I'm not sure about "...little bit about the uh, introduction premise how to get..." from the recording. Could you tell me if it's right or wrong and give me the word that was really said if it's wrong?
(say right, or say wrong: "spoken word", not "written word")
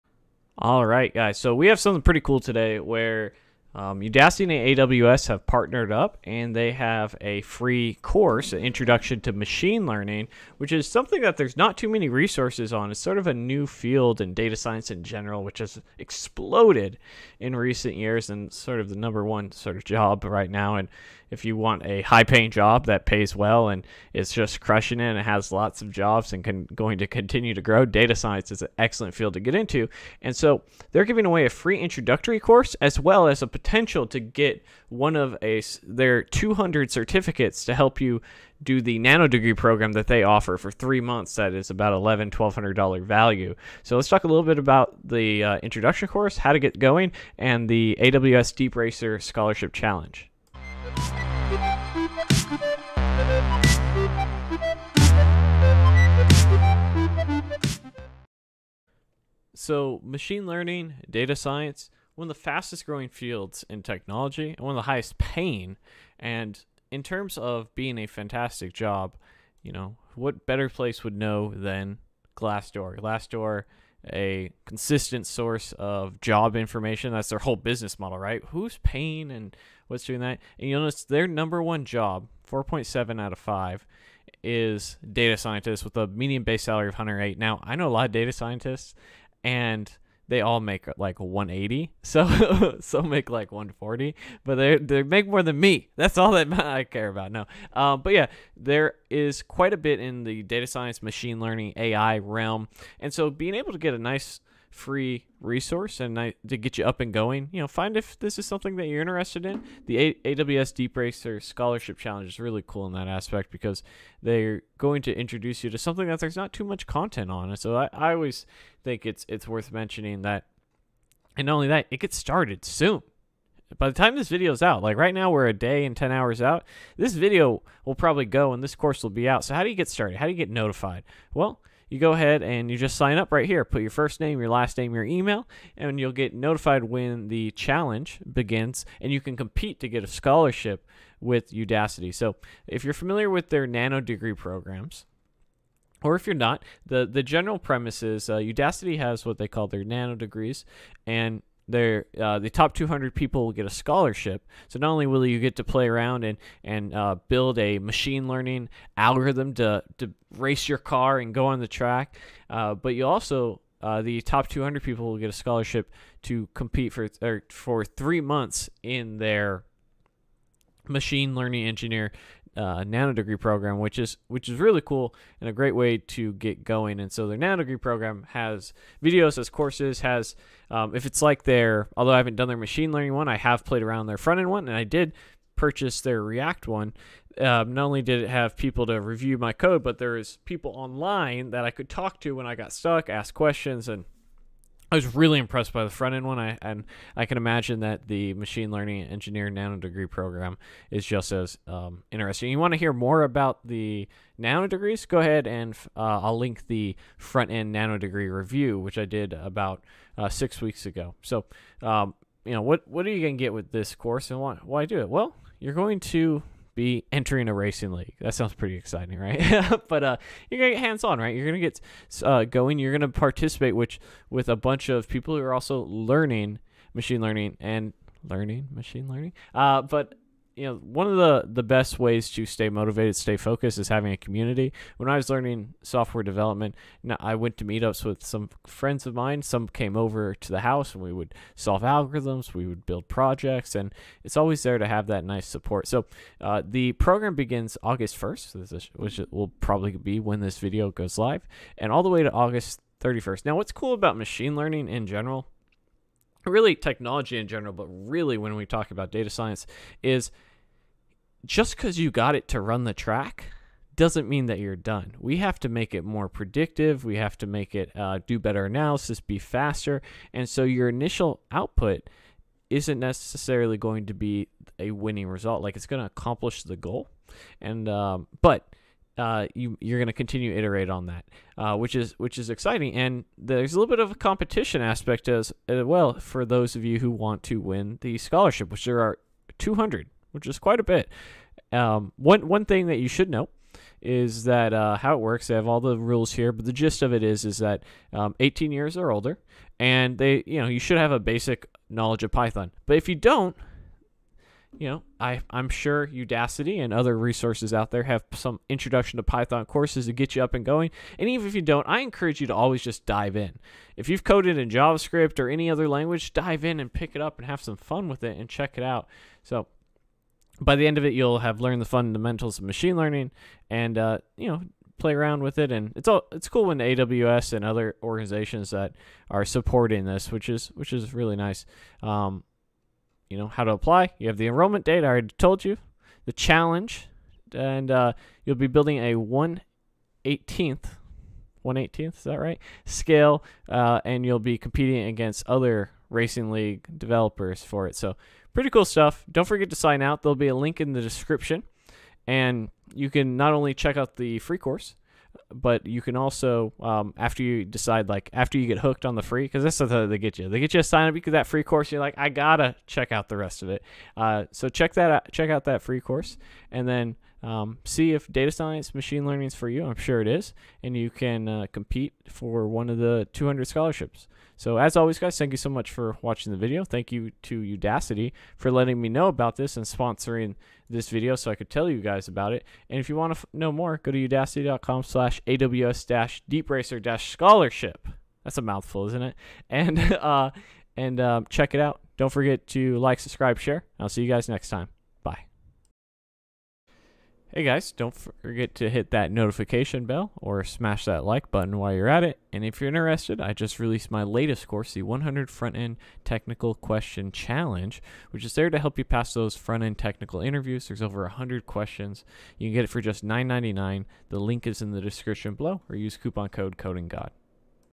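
wrong: "course", not "premise".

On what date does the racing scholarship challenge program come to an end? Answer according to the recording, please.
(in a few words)
August 31st.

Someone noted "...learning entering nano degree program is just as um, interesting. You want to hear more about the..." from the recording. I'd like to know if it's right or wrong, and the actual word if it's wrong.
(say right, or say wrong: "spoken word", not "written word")
wrong: "engineering", not "entering".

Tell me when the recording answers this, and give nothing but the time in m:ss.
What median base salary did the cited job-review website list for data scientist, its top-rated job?
1:26.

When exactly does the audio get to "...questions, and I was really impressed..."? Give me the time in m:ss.
3:13.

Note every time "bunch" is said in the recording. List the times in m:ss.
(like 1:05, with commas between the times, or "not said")
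3:44.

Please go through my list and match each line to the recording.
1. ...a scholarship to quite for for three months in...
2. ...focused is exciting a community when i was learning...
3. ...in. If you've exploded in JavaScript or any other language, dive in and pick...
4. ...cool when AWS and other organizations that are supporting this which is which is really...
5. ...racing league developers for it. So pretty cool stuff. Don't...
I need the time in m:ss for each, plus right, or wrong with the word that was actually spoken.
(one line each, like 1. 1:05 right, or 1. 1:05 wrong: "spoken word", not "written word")
1. 2:45 wrong: "compete", not "quite"
2. 3:53 wrong: "having", not "exciting"
3. 5:13 wrong: "coded", not "exploded"
4. 5:26 right
5. 5:46 right.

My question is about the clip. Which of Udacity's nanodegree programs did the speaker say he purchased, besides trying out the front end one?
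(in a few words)
React.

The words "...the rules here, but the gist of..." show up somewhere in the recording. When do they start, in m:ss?
4:55.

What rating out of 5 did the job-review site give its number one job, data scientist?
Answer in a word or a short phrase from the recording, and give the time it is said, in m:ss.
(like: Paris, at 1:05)
4.7, at 1:22.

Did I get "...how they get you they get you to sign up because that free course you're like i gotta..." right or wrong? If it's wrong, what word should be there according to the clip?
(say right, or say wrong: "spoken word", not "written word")
right.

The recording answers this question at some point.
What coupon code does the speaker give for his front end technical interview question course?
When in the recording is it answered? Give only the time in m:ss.
6:56.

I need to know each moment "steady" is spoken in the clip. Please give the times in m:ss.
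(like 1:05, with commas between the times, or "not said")
not said.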